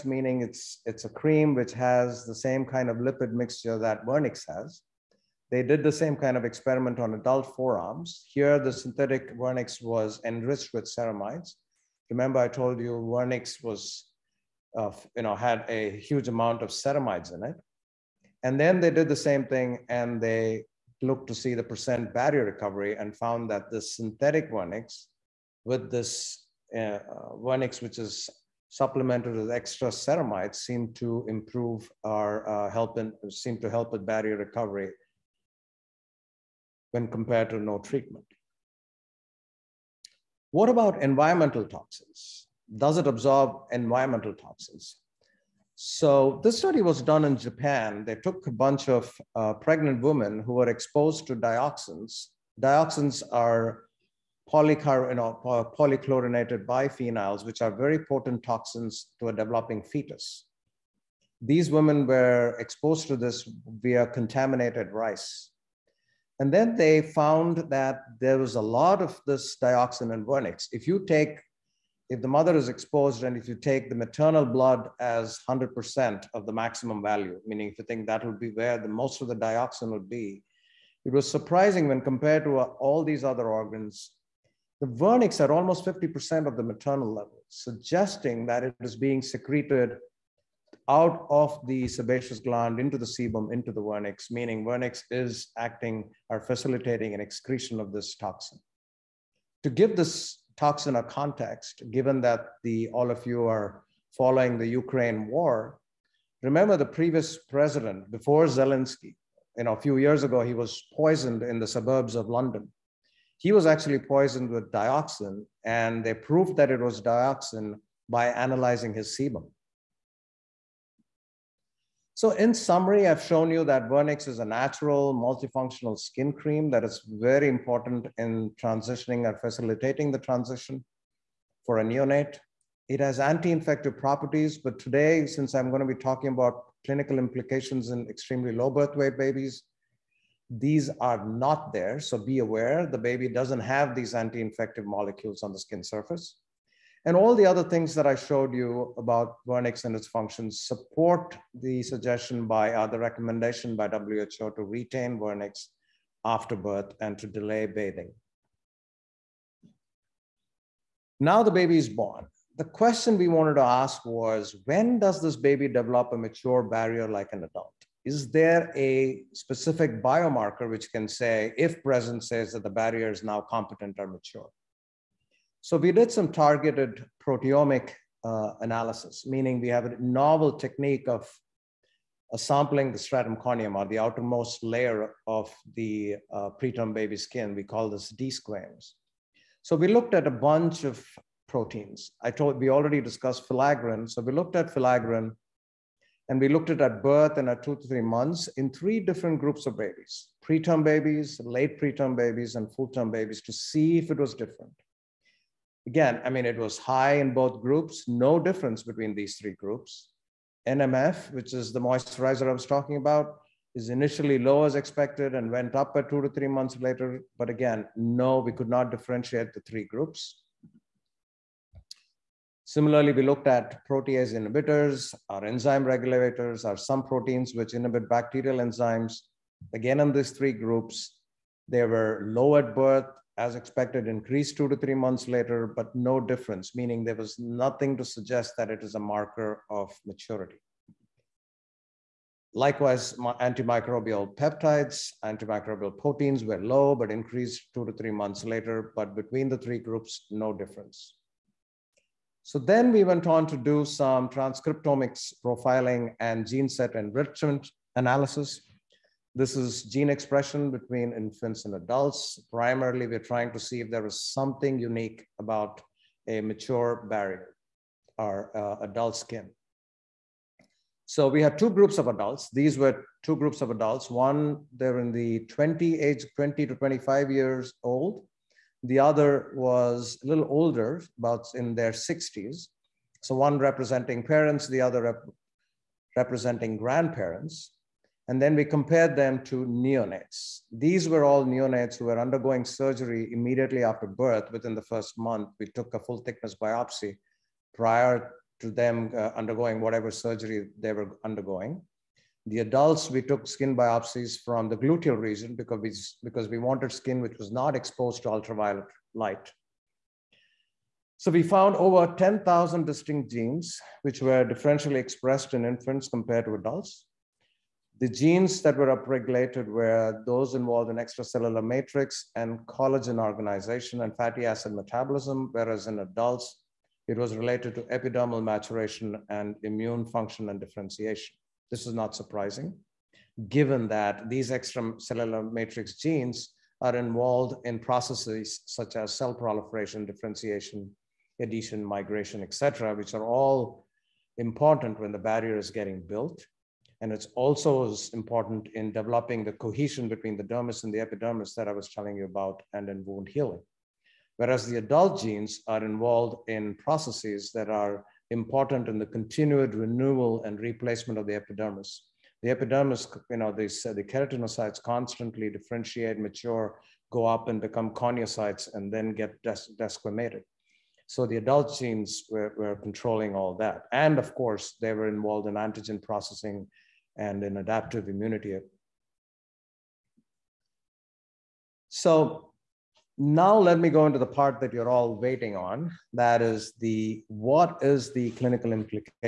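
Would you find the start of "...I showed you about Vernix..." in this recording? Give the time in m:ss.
2:28.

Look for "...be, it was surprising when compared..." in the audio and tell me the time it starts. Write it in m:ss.
1:20.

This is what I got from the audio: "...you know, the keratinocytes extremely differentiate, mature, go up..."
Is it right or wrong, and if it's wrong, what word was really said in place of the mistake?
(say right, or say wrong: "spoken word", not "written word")
wrong: "constantly", not "extremely".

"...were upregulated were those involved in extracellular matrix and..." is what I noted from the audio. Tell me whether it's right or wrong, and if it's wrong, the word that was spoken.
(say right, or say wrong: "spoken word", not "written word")
right.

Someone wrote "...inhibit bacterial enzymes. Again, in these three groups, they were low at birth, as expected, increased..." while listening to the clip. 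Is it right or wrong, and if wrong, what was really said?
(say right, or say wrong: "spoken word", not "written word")
right.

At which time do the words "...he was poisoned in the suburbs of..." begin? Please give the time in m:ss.
1:50.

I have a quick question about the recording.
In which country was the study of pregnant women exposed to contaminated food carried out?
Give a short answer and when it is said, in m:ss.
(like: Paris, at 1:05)
Japan, at 0:47.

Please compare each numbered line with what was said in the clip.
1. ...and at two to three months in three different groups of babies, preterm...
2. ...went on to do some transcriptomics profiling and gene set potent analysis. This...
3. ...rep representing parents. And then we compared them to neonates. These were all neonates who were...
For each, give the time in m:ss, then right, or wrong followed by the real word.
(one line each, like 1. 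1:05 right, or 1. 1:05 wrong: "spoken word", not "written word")
1. 3:17 right
2. 4:13 wrong: "enrichment", not "potent"
3. 4:45 wrong: "grandparents", not "parents".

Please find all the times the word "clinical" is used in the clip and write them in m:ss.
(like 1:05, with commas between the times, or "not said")
2:16, 6:28.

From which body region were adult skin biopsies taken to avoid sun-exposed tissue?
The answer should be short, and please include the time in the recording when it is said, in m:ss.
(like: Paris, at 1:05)
Gluteal region, at 5:04.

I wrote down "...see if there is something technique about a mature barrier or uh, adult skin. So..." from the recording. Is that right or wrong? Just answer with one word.
wrong.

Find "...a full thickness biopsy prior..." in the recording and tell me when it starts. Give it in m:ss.
4:55.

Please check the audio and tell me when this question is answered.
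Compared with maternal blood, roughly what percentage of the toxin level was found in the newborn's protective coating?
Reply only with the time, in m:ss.
1:25.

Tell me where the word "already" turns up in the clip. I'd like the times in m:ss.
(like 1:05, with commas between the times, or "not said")
3:12.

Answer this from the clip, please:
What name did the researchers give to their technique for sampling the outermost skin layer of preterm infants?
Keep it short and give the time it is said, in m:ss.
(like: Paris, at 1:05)
Desquams, at 3:08.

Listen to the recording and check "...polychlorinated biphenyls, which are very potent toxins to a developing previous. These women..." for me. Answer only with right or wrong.
wrong.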